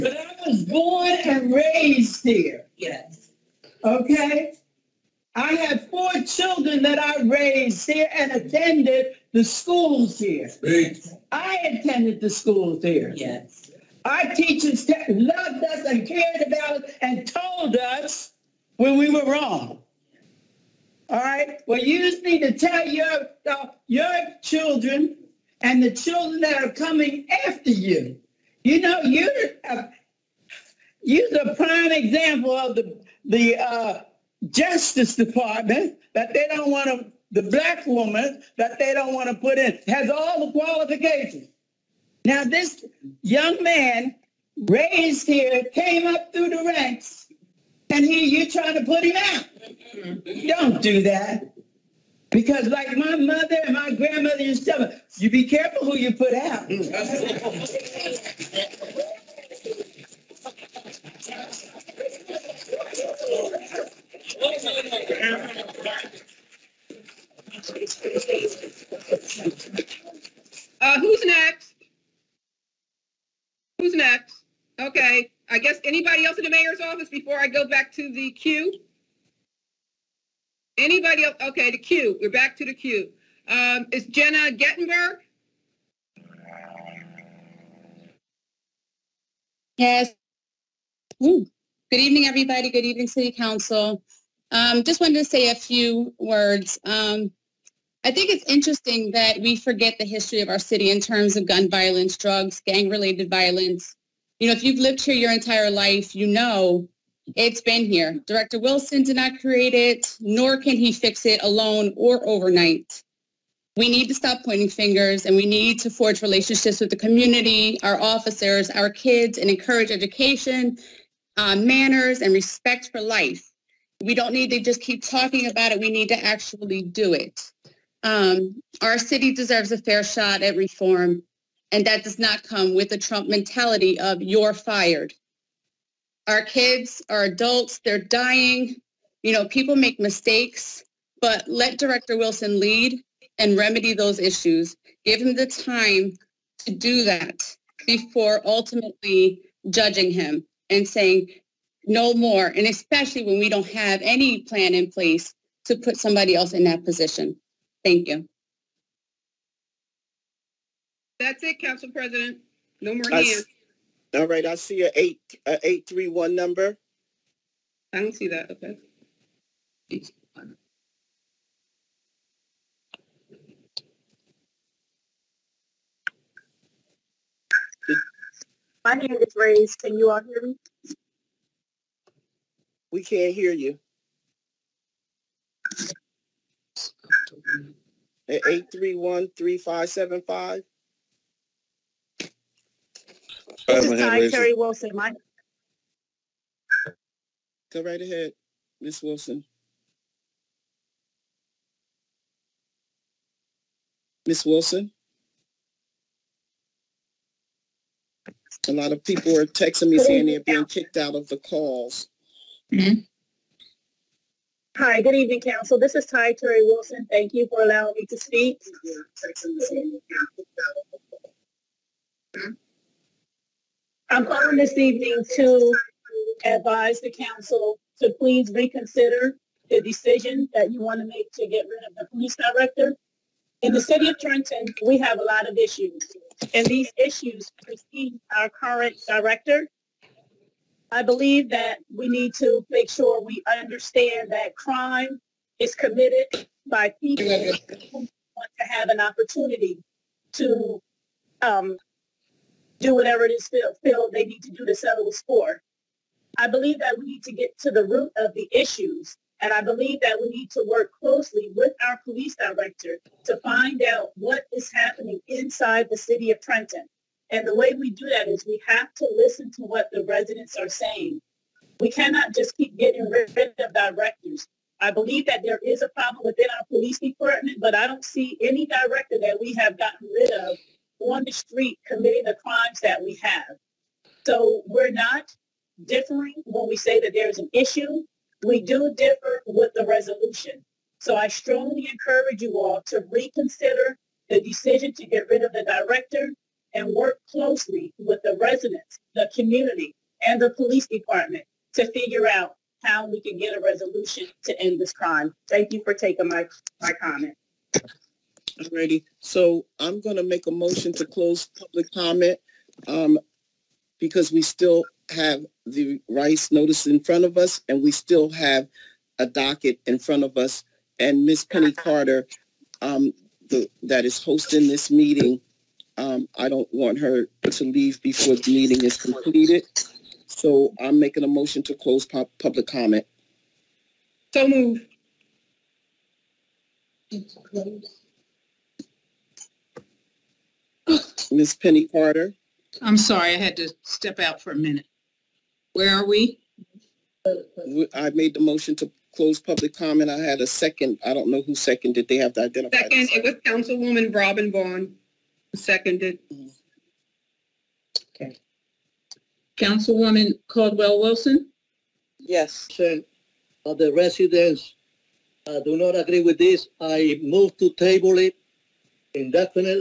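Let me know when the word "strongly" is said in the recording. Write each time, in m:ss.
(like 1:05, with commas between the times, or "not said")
4:51.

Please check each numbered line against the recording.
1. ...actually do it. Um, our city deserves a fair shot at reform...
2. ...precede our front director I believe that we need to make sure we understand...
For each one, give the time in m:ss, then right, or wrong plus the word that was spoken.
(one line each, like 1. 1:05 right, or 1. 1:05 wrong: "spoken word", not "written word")
1. 2:06 right
2. 3:57 wrong: "current", not "front".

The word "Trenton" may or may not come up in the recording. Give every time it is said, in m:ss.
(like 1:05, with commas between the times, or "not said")
3:54, 4:26.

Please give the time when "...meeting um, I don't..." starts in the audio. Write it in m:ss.
5:24.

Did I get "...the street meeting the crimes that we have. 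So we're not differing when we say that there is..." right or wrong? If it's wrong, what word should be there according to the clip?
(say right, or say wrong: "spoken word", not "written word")
wrong: "committing", not "meeting".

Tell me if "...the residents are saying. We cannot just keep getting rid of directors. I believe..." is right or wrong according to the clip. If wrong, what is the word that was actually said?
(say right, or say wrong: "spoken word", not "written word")
right.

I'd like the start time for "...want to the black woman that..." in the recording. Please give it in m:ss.
0:36.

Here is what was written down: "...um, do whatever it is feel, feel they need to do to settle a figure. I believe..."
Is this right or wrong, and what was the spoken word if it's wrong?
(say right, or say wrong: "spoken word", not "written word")
wrong: "score", not "figure".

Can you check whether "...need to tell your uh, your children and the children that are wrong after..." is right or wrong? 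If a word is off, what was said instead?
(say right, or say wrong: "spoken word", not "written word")
wrong: "coming", not "wrong".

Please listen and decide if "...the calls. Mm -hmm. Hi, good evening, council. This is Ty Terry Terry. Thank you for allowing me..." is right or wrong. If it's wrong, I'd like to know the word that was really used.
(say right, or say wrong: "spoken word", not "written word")
wrong: "Wilson", not "Terry".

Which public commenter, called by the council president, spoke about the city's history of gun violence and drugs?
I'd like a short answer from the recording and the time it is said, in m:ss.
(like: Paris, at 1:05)
Jenna Gettenberg, at 1:24.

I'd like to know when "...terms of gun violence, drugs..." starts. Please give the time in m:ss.
1:41.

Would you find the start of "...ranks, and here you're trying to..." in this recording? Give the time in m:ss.
0:46.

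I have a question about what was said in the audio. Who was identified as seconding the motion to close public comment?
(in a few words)
Robin Vaughn.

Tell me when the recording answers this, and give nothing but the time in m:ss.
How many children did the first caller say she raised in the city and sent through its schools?
0:05.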